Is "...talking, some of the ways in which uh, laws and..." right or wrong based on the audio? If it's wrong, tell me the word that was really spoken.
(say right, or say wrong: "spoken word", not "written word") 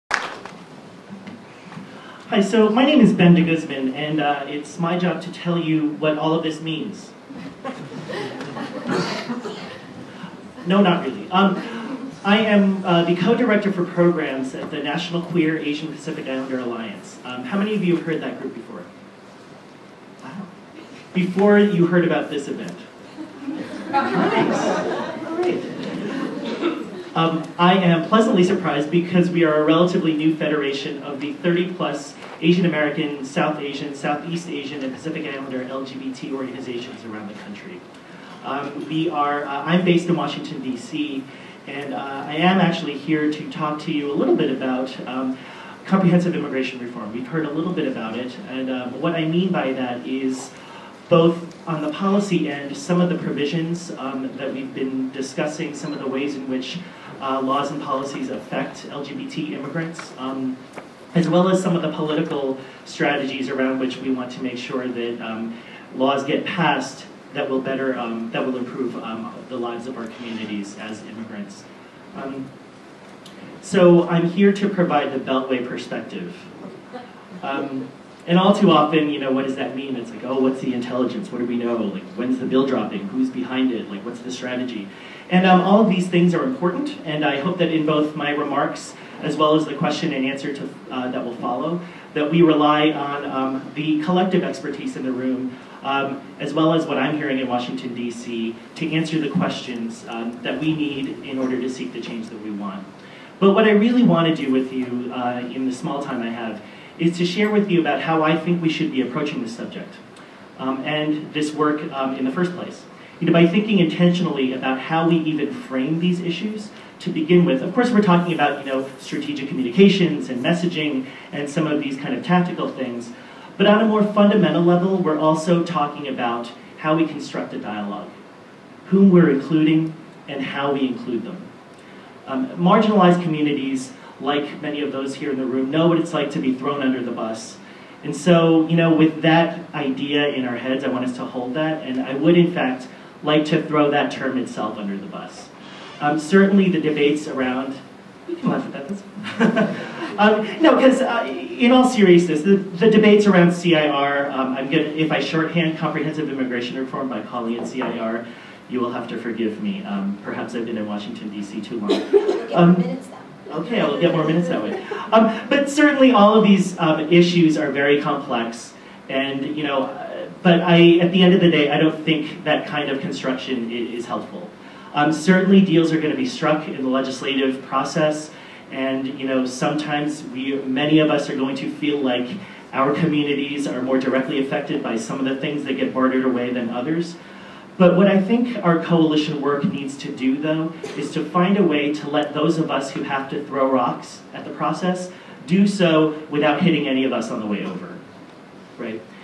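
wrong: "discussing", not "talking".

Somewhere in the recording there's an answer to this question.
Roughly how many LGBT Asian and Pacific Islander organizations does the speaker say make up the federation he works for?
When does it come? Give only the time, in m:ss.
0:31.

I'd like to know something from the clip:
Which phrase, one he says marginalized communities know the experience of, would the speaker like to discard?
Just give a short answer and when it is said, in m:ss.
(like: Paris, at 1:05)
thrown under the bus, at 2:16.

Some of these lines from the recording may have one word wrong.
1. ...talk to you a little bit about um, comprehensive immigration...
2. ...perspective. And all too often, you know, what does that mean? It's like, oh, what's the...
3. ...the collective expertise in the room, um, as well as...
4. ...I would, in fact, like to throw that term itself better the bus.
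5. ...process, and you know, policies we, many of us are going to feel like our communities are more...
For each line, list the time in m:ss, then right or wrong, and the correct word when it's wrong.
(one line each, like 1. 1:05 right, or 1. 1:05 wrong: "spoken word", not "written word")
1. 0:43 right
2. 1:15 right
3. 1:33 right
4. 2:22 wrong: "under", not "better"
5. 2:57 wrong: "sometimes", not "policies".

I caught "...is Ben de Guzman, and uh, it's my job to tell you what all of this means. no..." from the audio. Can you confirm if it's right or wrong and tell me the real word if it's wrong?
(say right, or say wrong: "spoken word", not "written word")
right.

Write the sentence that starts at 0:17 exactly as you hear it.
Um, how many of you have heard that group before?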